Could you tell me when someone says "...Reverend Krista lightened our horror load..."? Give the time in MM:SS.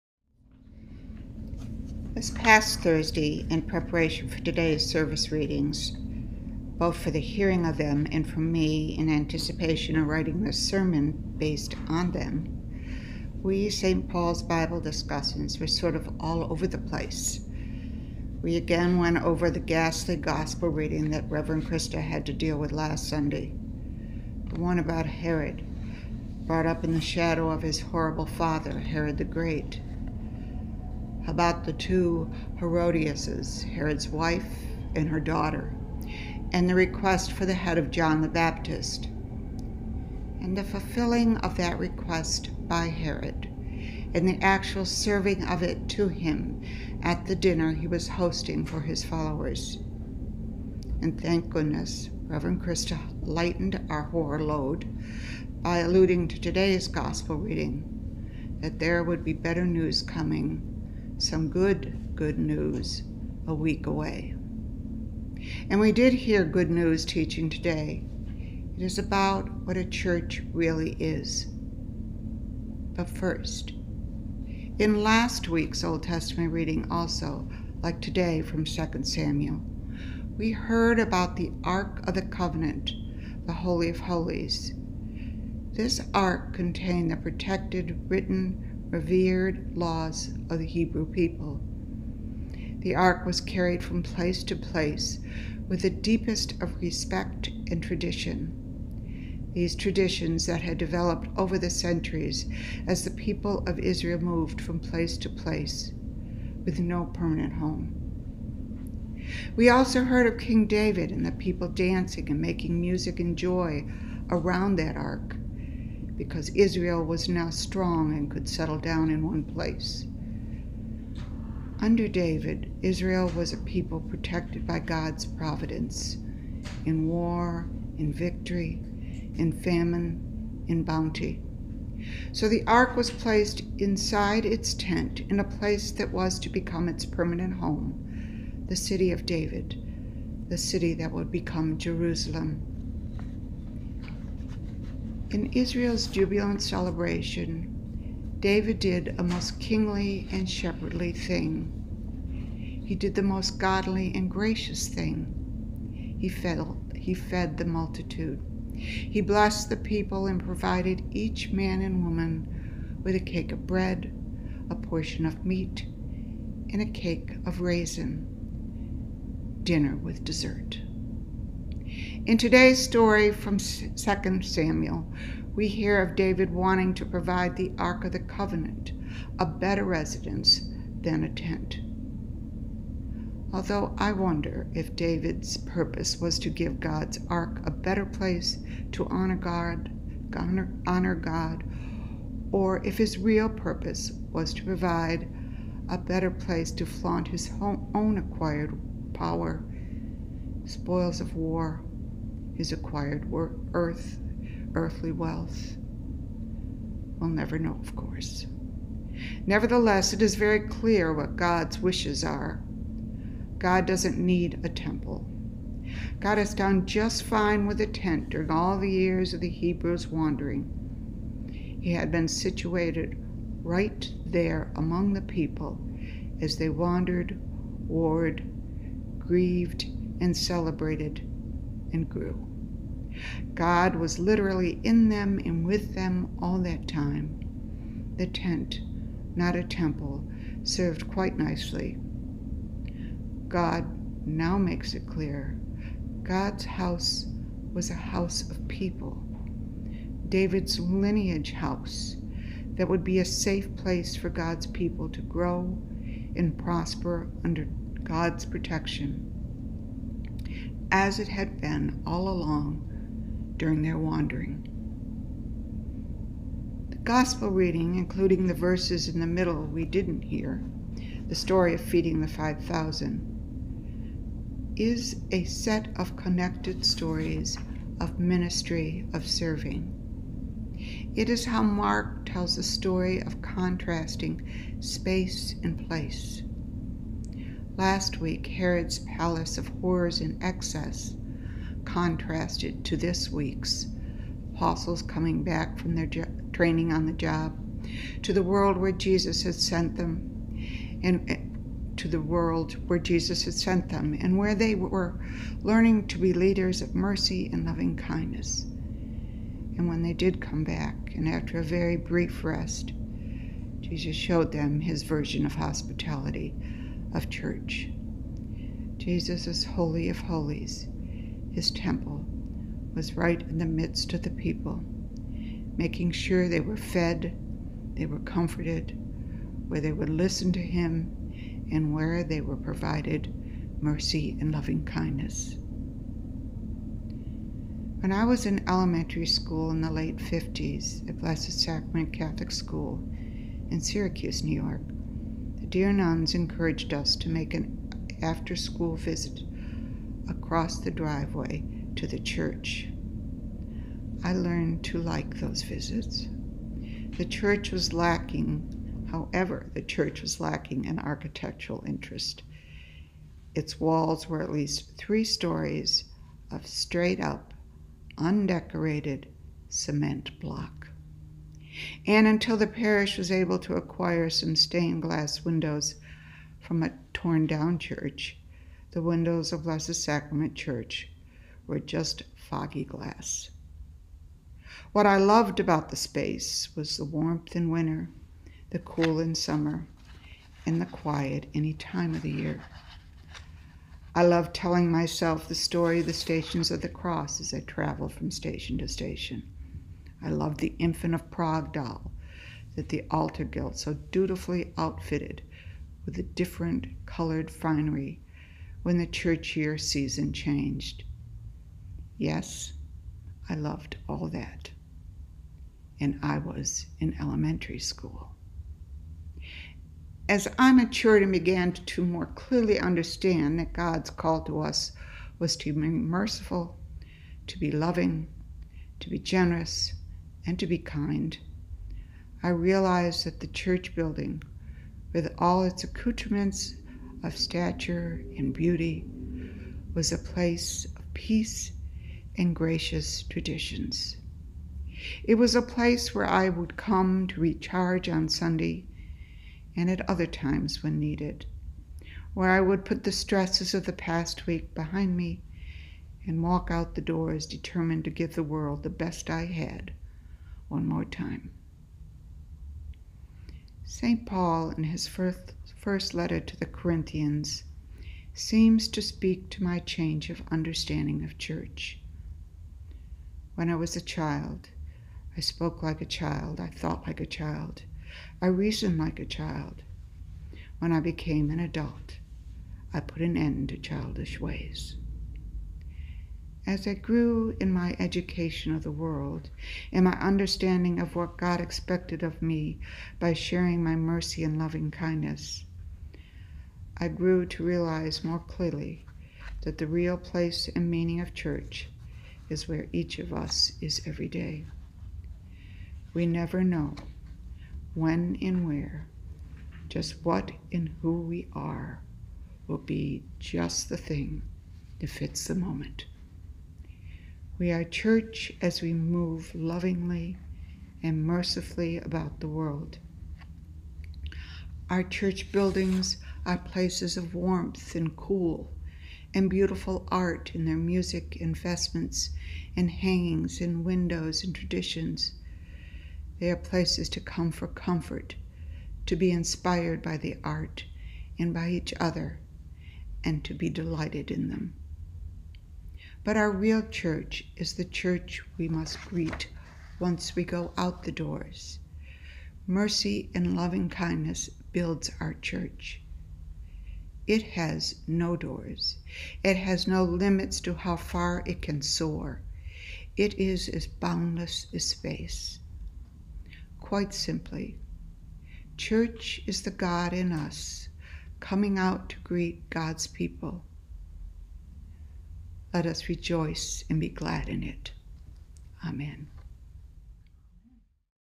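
00:52.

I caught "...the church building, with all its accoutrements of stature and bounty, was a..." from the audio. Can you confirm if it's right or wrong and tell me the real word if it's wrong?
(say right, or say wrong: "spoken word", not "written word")
wrong: "beauty", not "bounty".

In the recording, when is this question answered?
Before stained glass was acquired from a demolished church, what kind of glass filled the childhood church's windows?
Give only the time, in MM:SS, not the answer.
06:22.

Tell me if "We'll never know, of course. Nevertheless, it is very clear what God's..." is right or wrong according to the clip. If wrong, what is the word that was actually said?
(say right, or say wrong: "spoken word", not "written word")
right.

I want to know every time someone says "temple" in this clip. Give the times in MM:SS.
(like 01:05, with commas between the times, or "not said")
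03:34, 03:59, 05:21.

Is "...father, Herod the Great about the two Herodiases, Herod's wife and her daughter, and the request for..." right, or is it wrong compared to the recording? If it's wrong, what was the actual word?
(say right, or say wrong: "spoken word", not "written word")
right.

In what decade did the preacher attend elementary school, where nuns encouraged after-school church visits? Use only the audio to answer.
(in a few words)
The late 50s.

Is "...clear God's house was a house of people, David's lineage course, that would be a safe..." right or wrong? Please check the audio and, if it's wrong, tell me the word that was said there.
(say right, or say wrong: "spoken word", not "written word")
wrong: "house", not "course".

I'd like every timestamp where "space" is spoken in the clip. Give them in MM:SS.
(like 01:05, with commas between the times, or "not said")
04:44, 06:25, 09:24.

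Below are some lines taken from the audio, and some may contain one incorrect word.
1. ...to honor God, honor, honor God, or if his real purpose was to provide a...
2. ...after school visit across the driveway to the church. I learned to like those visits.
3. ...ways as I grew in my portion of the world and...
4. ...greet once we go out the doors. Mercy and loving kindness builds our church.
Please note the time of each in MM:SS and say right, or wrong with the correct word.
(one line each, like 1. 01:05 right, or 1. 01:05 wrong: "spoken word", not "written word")
1. 03:08 right
2. 05:48 right
3. 08:04 wrong: "education", not "portion"
4. 09:09 right.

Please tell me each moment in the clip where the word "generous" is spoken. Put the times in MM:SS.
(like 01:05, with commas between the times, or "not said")
07:09.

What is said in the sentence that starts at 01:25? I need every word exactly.
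This ark contained the protected written revered laws of the Hebrew people.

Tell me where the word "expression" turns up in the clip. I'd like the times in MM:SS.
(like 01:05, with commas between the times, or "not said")
not said.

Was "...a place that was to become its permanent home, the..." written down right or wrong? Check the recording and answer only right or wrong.
right.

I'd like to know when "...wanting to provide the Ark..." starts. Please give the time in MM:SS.
02:56.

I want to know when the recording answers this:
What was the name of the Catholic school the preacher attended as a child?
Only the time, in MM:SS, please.
05:41.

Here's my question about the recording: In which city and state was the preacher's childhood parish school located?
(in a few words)
Syracuse, New York.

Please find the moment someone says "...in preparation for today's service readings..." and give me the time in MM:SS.
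00:03.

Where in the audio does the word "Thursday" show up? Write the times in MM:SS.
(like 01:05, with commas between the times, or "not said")
00:02.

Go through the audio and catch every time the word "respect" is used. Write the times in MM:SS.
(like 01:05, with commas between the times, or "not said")
01:36.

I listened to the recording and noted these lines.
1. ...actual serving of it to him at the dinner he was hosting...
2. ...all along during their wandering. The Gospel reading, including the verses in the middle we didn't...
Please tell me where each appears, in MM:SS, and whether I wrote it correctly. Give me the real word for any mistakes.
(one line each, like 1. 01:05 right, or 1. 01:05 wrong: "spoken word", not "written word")
1. 00:44 right
2. 04:22 right.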